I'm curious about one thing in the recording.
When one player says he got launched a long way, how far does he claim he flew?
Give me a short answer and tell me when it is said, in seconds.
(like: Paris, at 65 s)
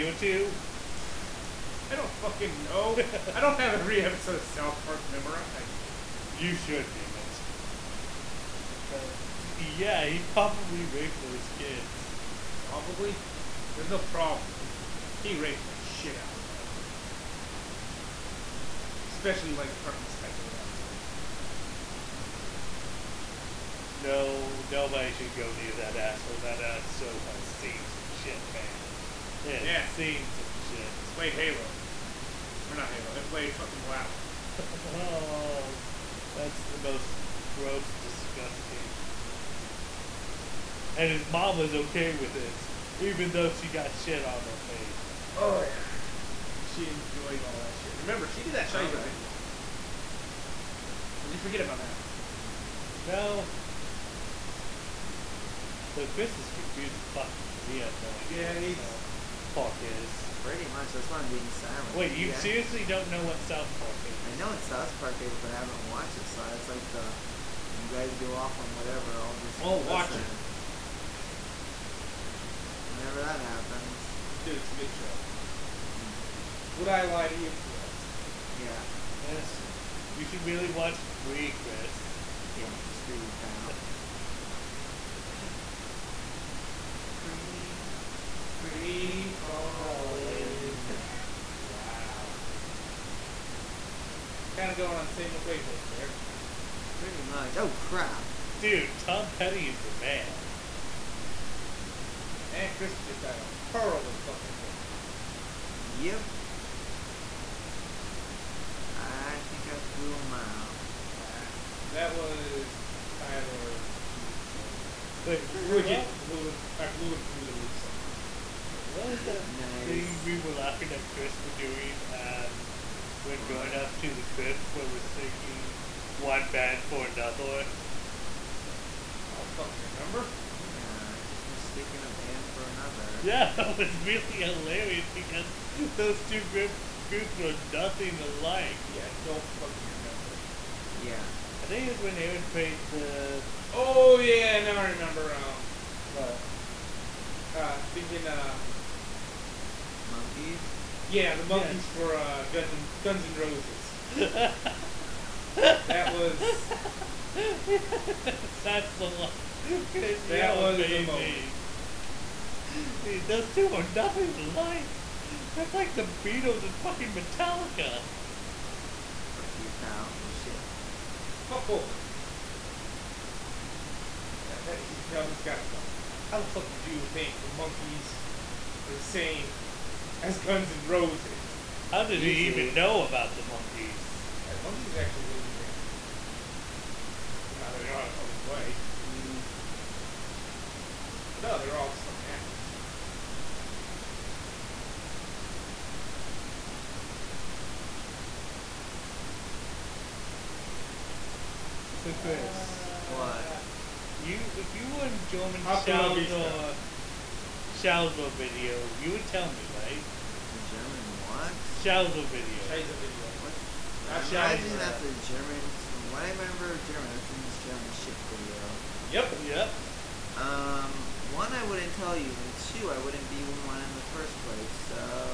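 a mile, at 110 s.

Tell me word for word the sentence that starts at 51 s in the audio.
Or did you forget about that?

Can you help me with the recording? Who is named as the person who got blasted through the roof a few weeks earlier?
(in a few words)
Tyler.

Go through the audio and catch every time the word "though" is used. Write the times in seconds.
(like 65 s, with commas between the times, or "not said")
43 s, 55 s.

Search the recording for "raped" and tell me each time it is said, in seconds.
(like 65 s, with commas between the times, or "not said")
10 s, 15 s.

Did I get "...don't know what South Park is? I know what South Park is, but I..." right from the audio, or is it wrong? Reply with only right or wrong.
right.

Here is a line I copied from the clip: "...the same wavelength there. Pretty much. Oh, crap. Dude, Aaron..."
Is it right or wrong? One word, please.
wrong.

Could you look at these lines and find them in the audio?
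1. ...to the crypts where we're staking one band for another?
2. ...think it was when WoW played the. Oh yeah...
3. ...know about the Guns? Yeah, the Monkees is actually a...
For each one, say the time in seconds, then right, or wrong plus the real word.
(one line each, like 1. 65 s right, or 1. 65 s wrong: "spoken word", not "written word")
1. 123 s right
2. 141 s wrong: "Aaron", not "WoW"
3. 182 s wrong: "Monkees", not "Guns".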